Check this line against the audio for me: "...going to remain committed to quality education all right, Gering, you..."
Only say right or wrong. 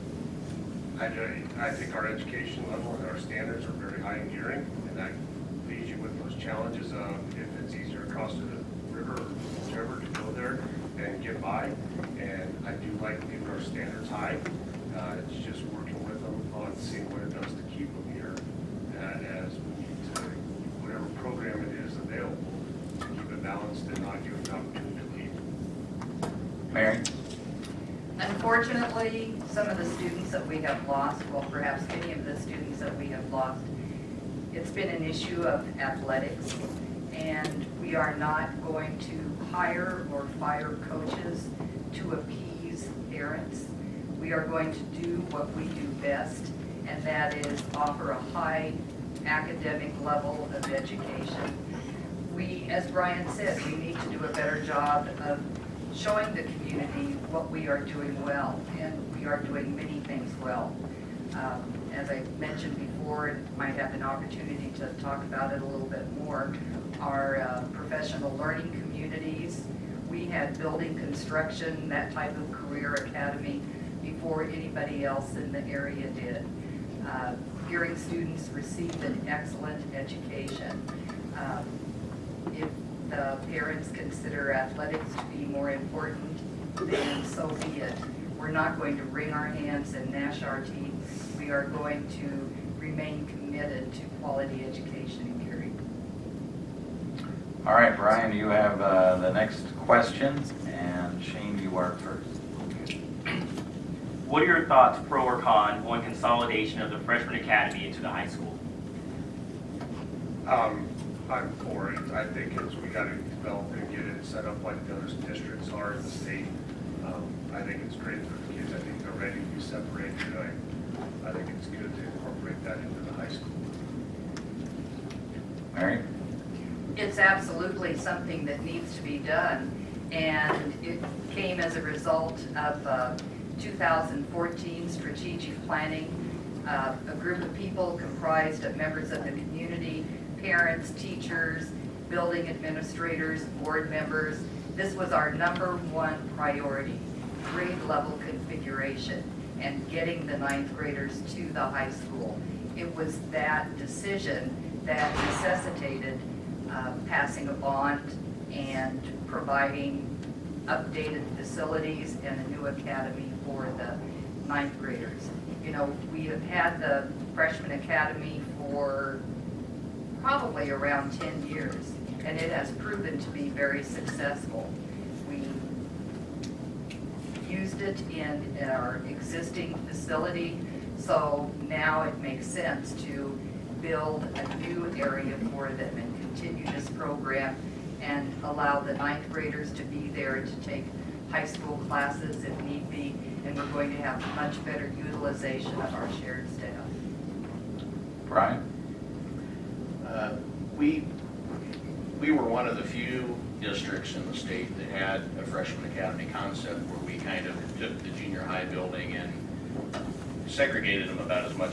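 wrong.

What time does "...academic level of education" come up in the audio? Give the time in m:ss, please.
0:49.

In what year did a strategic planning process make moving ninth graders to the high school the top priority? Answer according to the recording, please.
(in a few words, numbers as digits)
2014.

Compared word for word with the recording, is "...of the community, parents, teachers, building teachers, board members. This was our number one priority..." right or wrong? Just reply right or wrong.
wrong.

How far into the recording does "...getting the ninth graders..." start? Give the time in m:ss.
2:29.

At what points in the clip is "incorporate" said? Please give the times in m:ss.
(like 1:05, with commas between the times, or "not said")
2:02.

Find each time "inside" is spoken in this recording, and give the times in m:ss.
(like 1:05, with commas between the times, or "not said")
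not said.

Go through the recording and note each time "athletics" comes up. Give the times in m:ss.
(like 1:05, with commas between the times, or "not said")
0:35, 1:24.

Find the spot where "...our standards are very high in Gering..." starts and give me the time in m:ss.
0:03.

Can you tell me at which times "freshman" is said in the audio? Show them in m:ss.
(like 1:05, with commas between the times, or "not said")
1:46, 2:47, 3:25.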